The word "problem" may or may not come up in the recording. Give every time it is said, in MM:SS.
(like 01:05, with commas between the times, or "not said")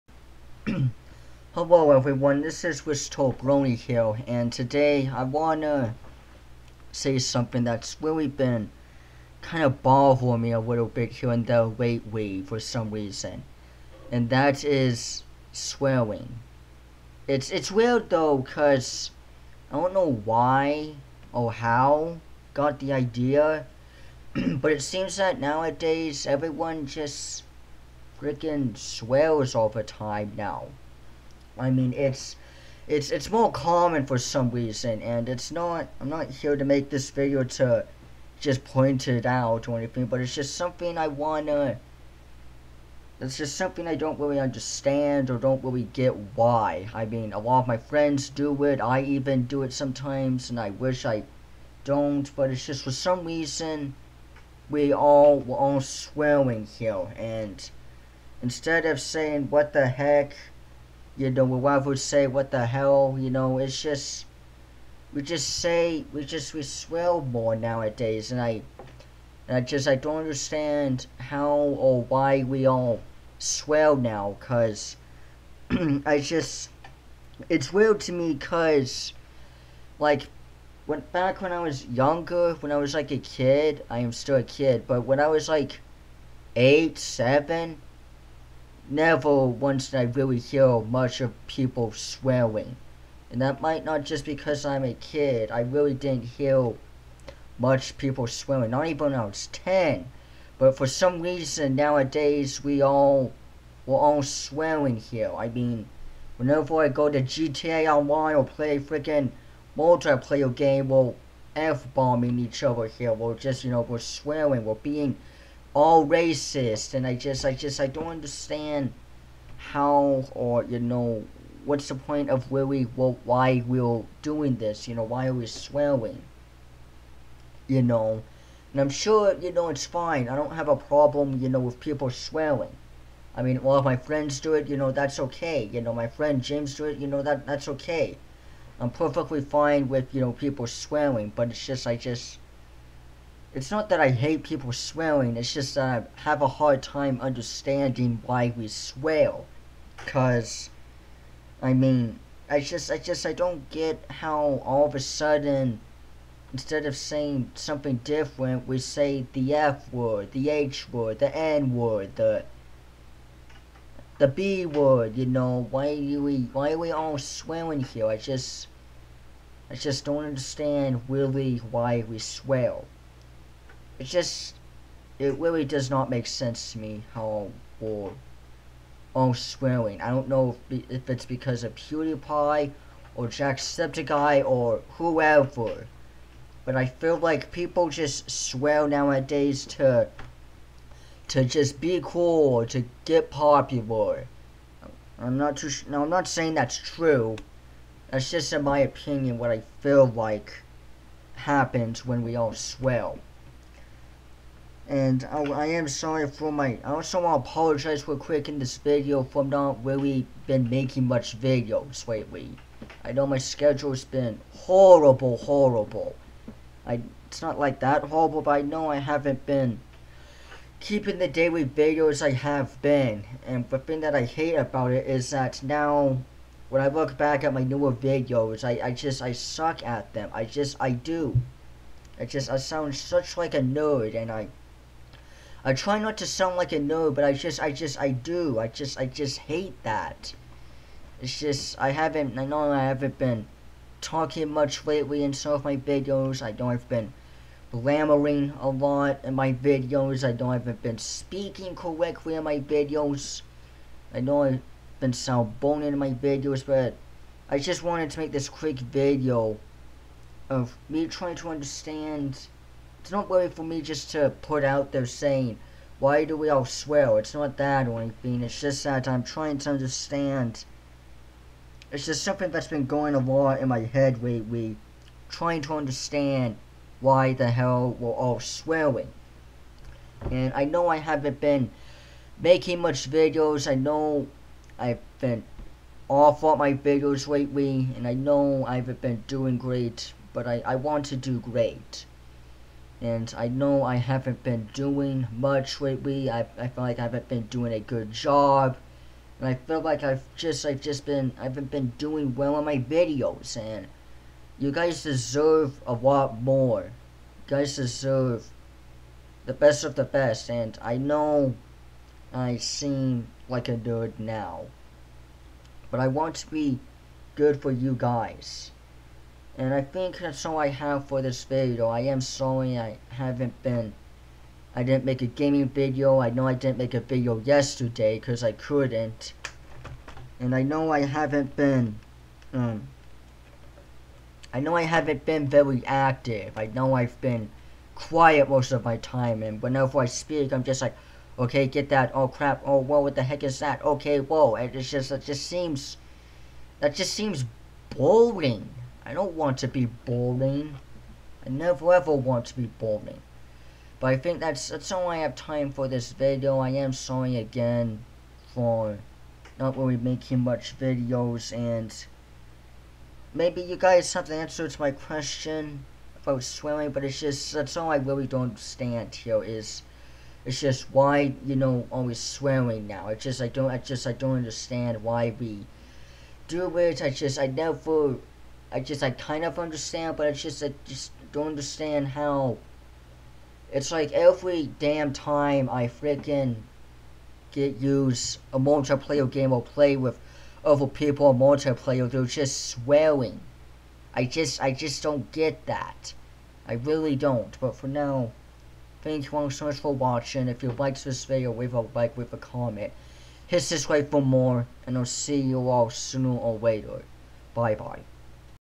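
02:10.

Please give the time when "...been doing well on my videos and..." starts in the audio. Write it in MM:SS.
05:01.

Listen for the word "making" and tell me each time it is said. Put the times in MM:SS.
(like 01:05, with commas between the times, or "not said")
03:30, 04:42, 05:59.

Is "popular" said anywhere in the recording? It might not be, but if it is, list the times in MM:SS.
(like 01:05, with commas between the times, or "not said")
03:13.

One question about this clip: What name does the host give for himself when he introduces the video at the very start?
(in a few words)
Risto Brony.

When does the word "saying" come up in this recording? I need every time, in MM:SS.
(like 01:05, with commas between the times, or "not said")
00:58, 02:36, 03:16, 04:25.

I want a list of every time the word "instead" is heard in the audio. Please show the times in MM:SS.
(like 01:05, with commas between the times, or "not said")
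00:58, 02:36.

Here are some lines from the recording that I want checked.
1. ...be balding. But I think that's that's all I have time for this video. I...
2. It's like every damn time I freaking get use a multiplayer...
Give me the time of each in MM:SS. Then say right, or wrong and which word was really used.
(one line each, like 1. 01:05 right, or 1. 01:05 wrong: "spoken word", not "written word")
1. 05:52 right
2. 06:23 right.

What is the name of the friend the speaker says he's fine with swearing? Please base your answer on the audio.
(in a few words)
James.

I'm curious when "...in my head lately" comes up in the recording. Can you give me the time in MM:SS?
04:33.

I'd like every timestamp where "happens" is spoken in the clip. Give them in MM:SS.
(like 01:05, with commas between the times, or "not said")
03:21.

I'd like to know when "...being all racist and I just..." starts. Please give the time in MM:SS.
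01:54.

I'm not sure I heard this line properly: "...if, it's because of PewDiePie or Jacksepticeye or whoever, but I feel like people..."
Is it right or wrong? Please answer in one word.
right.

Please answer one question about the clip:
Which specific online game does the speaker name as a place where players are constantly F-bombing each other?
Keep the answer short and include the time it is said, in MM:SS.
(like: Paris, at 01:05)
GTA Online, at 01:47.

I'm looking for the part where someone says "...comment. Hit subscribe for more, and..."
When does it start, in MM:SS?
06:42.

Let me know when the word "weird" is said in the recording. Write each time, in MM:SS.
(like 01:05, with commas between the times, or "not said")
00:17, 01:17.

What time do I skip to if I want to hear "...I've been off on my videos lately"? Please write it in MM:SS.
04:44.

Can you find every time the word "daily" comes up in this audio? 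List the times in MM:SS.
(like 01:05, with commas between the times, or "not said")
03:41.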